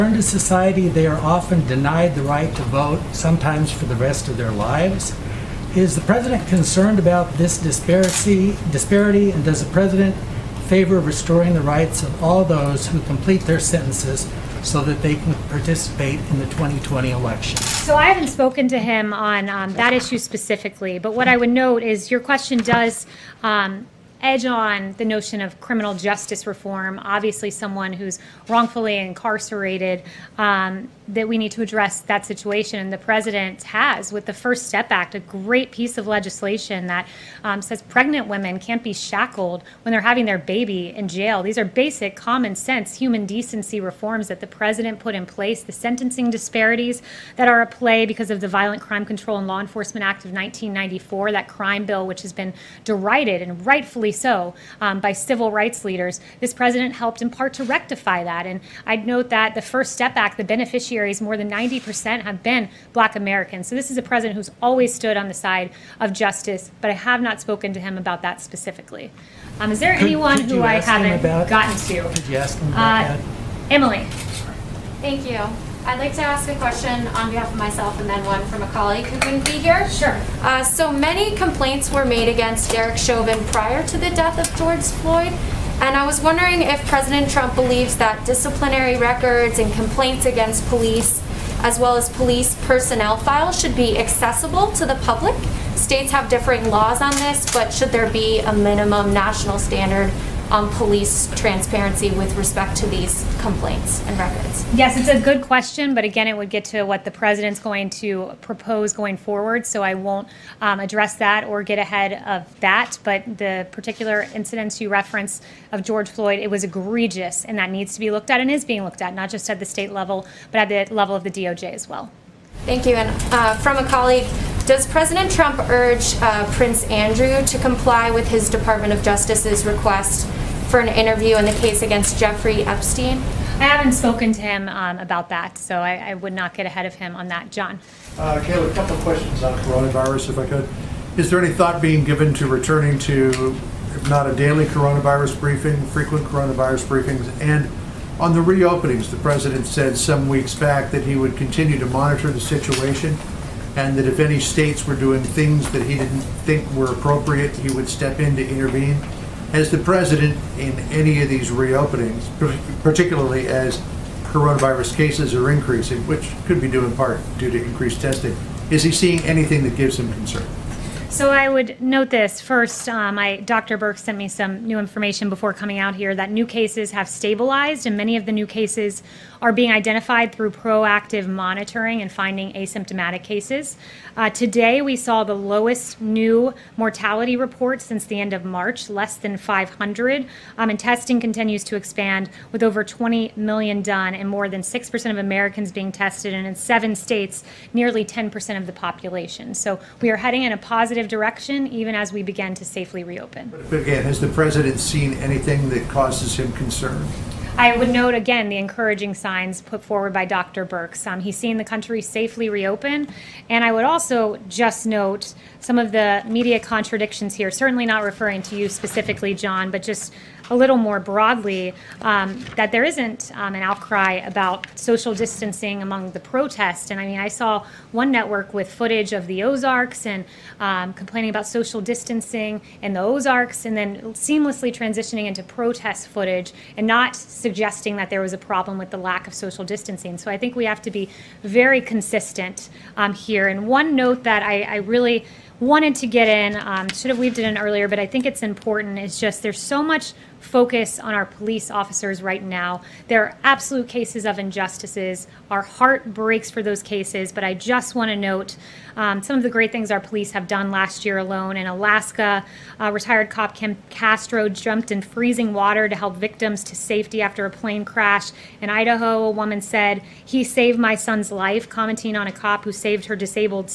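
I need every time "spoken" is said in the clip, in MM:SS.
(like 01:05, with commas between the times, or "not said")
00:18, 01:07, 02:13.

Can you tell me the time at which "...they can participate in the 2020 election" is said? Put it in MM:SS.
00:15.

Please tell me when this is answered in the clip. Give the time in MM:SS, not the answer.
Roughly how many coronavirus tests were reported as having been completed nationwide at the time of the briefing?
03:12.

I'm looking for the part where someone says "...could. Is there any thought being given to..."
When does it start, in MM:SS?
02:20.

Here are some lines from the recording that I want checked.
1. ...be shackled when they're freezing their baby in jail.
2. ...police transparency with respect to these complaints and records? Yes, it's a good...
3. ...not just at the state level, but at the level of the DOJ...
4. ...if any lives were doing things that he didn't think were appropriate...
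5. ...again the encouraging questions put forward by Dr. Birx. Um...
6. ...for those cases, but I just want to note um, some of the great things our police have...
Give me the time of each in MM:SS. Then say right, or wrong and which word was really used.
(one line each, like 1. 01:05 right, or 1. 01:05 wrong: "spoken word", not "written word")
1. 00:38 wrong: "having", not "freezing"
2. 01:40 right
3. 01:59 right
4. 02:34 wrong: "states", not "lives"
5. 03:28 wrong: "signs", not "questions"
6. 04:16 right.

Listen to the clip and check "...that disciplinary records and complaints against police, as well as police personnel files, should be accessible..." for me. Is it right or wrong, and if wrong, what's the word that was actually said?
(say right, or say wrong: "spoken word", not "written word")
right.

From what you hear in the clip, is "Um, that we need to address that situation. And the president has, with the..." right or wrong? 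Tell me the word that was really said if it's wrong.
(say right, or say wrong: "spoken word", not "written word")
right.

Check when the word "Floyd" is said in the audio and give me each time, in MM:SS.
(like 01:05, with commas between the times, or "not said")
01:25, 01:56.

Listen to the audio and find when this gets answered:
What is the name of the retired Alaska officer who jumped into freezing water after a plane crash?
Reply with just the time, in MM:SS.
04:23.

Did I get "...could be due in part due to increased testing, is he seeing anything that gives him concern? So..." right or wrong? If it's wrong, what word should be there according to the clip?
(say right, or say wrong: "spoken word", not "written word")
right.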